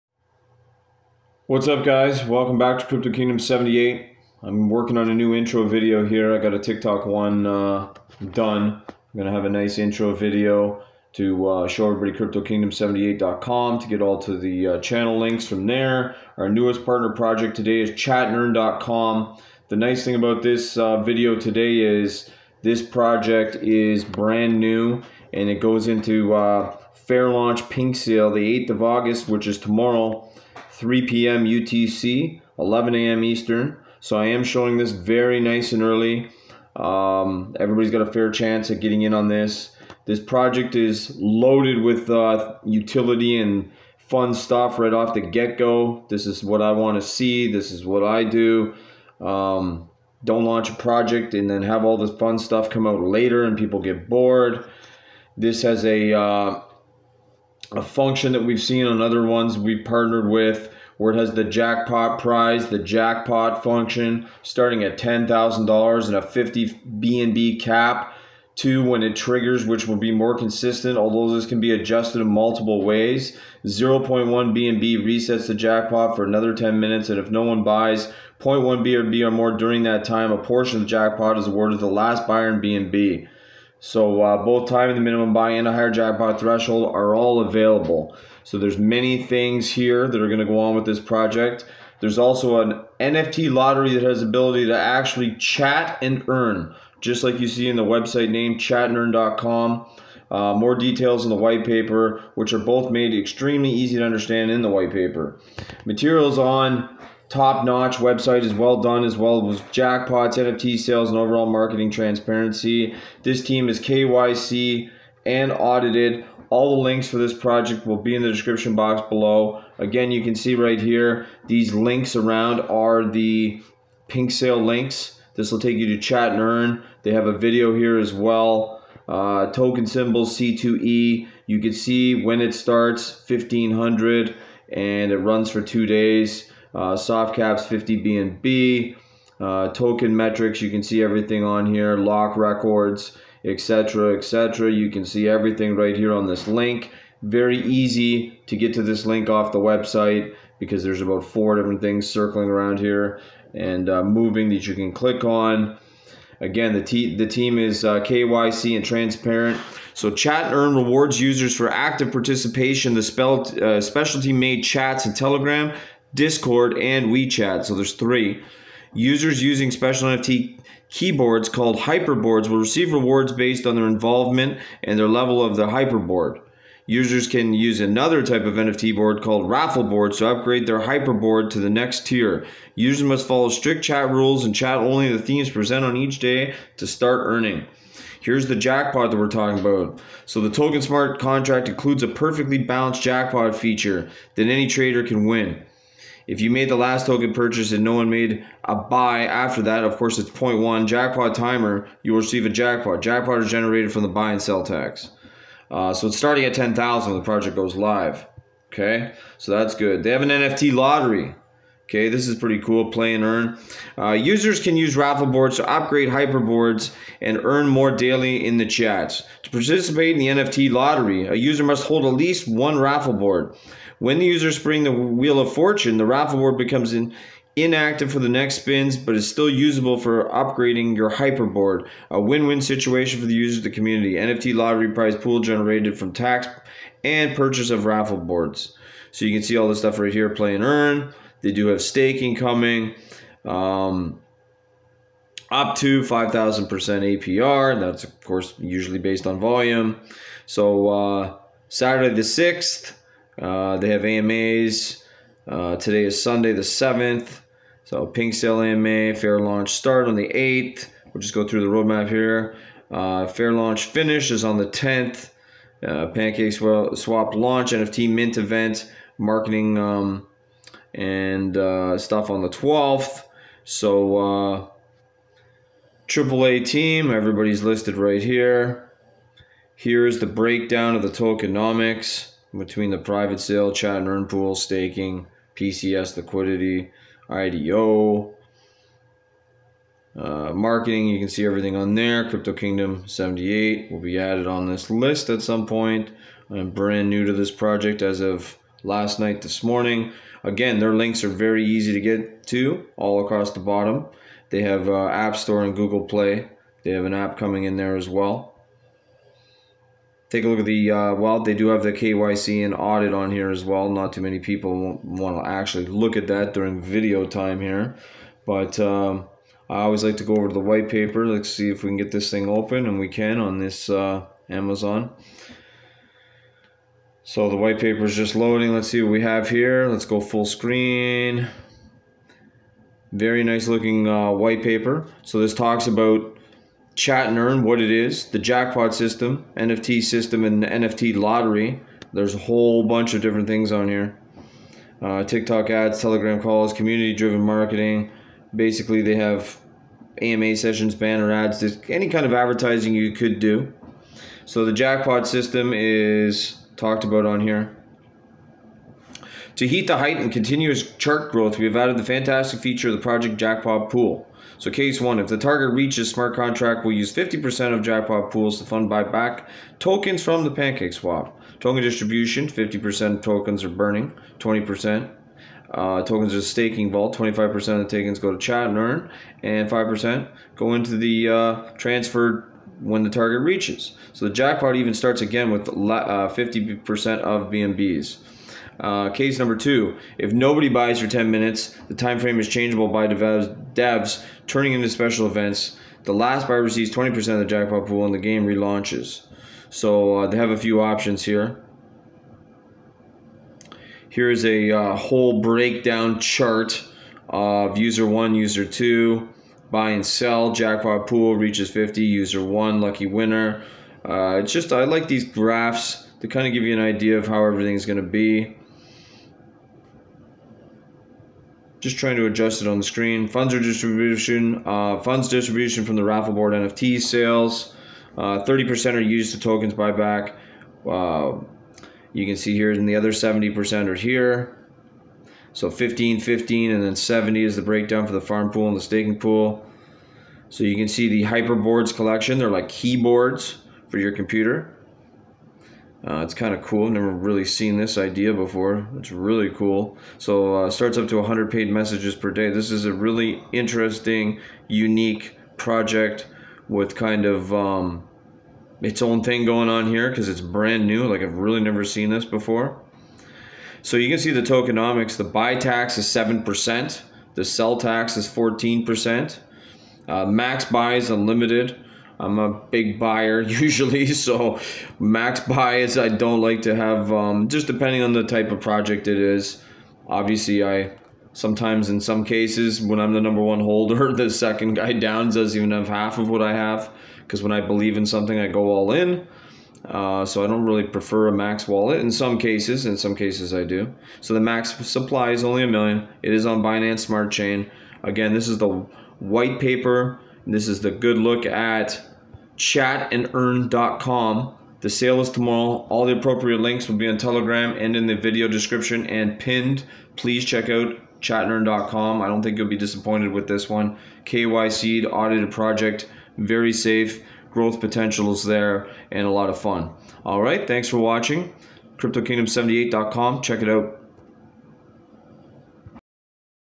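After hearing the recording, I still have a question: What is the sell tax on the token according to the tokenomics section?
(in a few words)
14%.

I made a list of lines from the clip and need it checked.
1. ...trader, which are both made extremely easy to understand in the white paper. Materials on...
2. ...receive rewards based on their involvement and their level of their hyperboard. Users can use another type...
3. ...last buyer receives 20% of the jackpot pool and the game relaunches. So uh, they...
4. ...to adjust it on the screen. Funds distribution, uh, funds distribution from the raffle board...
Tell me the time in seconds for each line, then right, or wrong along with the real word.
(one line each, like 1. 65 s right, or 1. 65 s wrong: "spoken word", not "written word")
1. 101 s wrong: "paper", not "trader"
2. 172 s right
3. 396 s right
4. 422 s right.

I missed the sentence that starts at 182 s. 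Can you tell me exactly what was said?
Users must follow strict chat rules and chat only the themes present on each day to start earning.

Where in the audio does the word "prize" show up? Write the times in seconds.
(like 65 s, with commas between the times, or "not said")
62 s, 234 s.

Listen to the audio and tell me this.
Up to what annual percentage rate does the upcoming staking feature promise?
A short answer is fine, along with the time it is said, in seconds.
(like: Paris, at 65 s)
5,000%, at 246 s.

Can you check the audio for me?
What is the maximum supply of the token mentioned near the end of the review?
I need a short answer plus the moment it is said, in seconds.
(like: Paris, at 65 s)
1 million, at 495 s.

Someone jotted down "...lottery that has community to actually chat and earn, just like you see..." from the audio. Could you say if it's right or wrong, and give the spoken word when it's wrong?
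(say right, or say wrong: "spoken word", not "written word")
wrong: "ability", not "community".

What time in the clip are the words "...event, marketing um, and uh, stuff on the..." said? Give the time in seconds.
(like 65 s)
268 s.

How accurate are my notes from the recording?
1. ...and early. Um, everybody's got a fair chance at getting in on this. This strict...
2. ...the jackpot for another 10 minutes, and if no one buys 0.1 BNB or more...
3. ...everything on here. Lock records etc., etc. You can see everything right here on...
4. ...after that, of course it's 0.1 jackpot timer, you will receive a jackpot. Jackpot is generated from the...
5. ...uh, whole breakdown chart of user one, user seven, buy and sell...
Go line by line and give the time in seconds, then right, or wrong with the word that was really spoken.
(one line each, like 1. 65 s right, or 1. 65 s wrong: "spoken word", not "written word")
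1. 35 s wrong: "project", not "strict"
2. 75 s right
3. 141 s right
4. 199 s right
5. 404 s wrong: "two", not "seven".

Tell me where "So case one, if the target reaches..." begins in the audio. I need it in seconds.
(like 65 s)
364 s.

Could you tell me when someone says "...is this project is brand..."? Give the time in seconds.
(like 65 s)
21 s.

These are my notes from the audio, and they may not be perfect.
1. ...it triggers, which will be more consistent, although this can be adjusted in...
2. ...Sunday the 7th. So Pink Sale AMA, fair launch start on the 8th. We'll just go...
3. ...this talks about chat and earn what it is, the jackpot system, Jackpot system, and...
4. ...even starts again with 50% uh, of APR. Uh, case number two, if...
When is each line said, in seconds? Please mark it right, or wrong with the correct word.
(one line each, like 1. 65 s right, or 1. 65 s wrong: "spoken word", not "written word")
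1. 69 s right
2. 256 s right
3. 335 s wrong: "NFT", not "Jackpot"
4. 384 s wrong: "BNBs", not "APR".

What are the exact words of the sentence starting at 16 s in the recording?
Our newest partner project today is chatandearn.com.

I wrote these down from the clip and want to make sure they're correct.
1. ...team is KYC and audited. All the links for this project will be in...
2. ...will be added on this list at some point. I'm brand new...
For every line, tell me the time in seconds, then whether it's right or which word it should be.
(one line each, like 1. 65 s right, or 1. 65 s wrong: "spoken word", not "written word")
1. 113 s right
2. 293 s right.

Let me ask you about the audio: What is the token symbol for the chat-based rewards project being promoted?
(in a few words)
C2E.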